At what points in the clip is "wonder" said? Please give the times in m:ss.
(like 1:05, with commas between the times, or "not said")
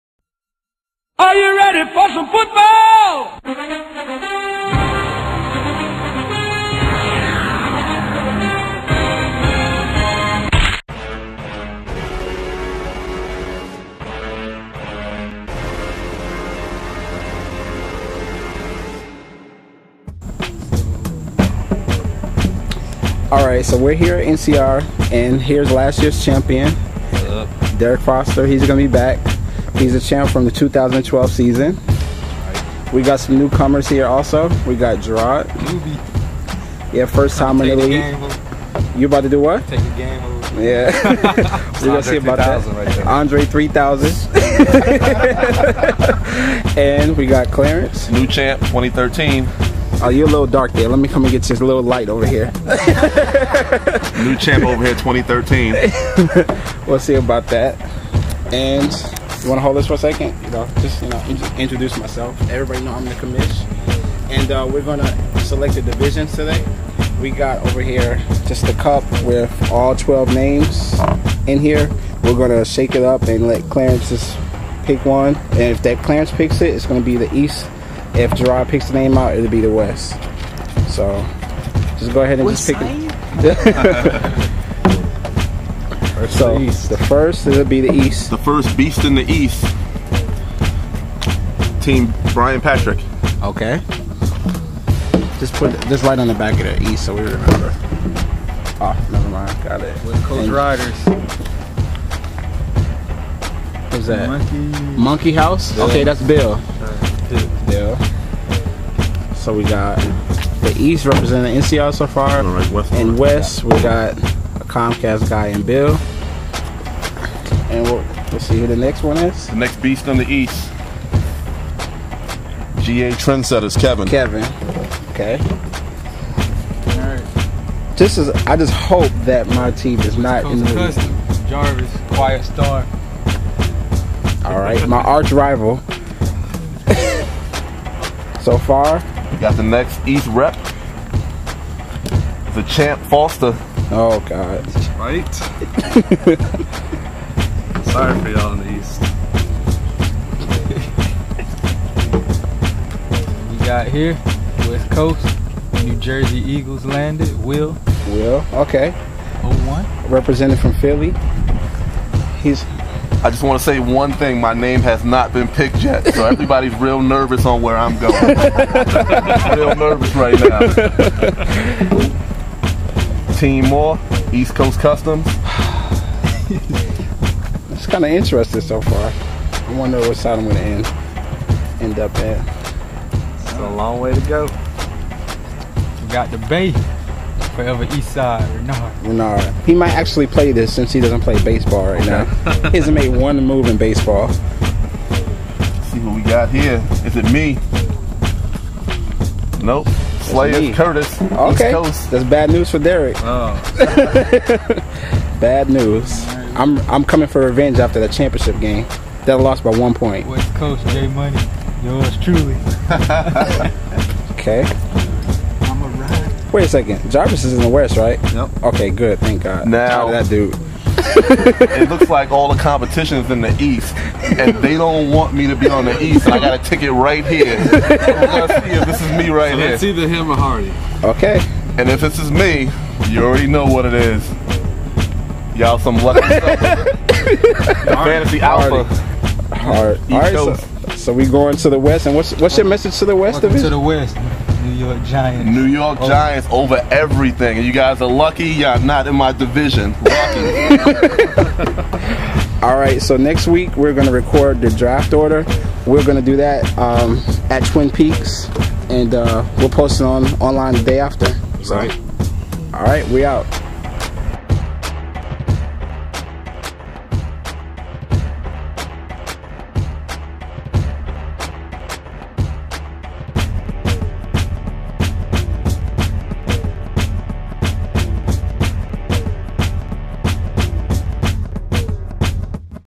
2:59.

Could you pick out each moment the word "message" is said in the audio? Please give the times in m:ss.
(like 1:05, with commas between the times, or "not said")
4:02.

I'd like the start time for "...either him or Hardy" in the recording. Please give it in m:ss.
3:49.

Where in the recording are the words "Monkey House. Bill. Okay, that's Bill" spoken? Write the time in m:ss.
1:45.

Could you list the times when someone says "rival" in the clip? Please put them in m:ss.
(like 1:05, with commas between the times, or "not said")
2:15.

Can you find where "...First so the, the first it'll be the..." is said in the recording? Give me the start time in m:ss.
1:26.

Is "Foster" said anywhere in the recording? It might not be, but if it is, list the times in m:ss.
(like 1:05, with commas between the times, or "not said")
0:28, 2:23.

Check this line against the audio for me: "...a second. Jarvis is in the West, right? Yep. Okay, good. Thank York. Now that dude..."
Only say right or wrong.
wrong.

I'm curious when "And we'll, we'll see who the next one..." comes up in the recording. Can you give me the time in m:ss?
1:57.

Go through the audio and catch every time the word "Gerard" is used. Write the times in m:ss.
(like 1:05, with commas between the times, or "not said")
0:35, 1:18.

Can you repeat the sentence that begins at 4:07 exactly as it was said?
you guys are lucky y'all not in my division.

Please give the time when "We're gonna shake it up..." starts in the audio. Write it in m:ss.
1:12.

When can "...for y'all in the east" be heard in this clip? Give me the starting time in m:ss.
2:28.